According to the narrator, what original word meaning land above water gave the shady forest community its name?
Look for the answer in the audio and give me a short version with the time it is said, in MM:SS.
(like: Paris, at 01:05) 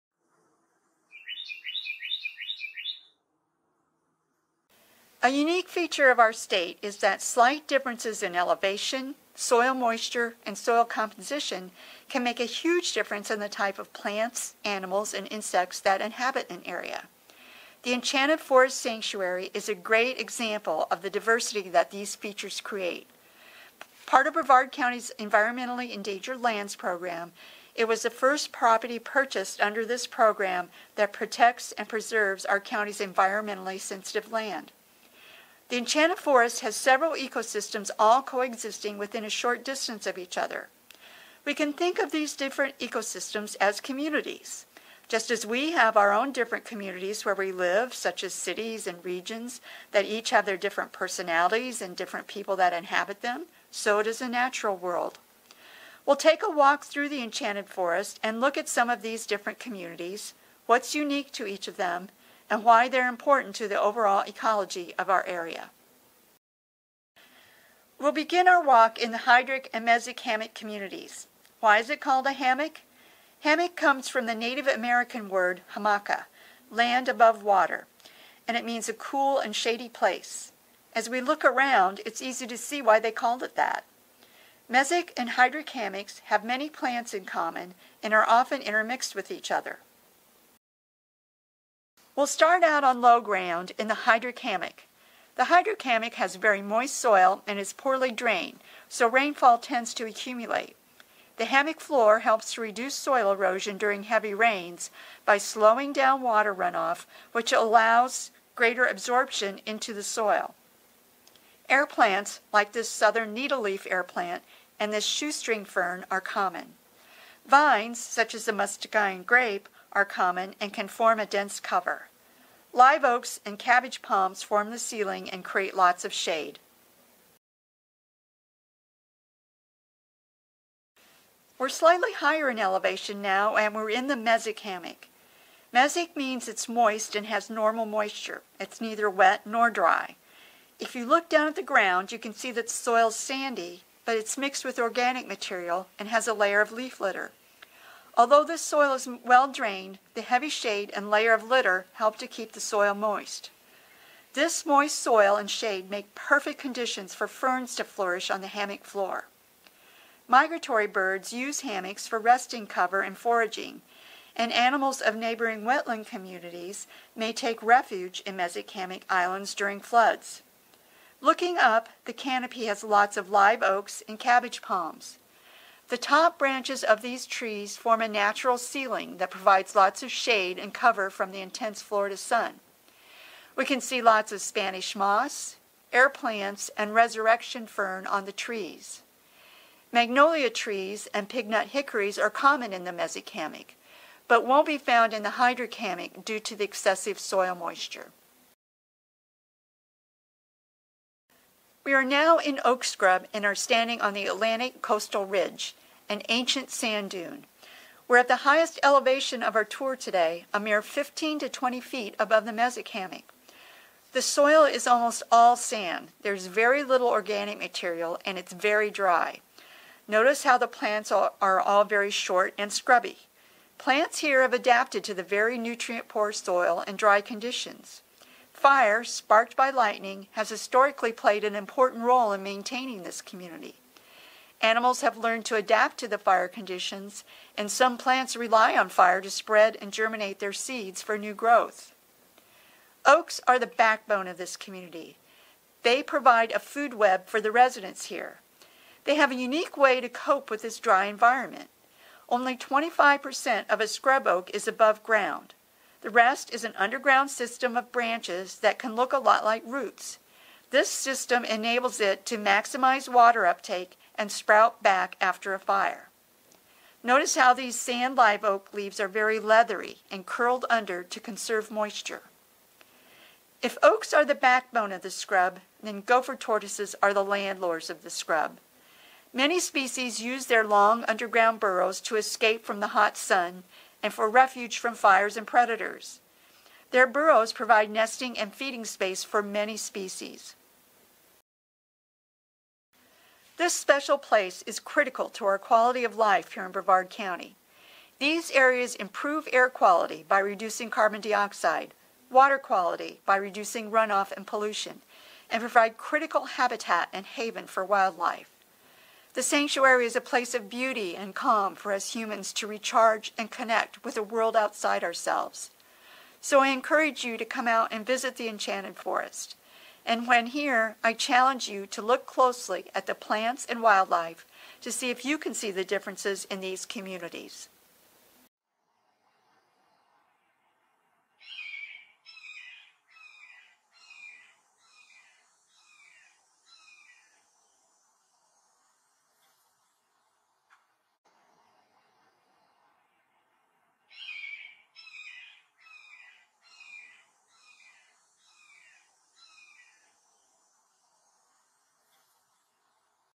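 hamaca, at 01:15.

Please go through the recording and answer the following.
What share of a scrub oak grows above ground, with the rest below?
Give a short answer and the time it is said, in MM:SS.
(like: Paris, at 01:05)
25%, at 04:12.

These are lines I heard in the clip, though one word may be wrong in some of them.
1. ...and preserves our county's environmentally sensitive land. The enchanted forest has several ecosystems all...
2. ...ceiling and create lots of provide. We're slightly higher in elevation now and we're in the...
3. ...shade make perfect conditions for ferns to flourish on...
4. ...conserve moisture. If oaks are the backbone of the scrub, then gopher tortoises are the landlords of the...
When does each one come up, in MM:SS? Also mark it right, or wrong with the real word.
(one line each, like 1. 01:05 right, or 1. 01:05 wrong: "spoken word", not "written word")
1. 00:31 right
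2. 02:04 wrong: "shade", not "provide"
3. 02:35 right
4. 04:31 right.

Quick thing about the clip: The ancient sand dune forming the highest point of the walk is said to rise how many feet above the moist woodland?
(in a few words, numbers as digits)
15 to 20 feet.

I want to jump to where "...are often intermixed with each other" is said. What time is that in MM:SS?
01:28.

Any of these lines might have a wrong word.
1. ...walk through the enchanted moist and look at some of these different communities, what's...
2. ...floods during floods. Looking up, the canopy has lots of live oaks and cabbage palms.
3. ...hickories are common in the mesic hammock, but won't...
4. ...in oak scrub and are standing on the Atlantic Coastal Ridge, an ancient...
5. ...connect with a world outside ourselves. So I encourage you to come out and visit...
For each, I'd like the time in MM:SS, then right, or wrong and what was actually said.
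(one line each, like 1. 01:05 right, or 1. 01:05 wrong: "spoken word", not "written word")
1. 00:56 wrong: "forest", not "moist"
2. 02:49 wrong: "islands", not "floods"
3. 03:11 right
4. 03:22 right
5. 05:13 right.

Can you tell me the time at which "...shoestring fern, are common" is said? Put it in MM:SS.
01:55.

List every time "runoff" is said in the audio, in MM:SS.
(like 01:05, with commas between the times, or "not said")
01:46, 05:03.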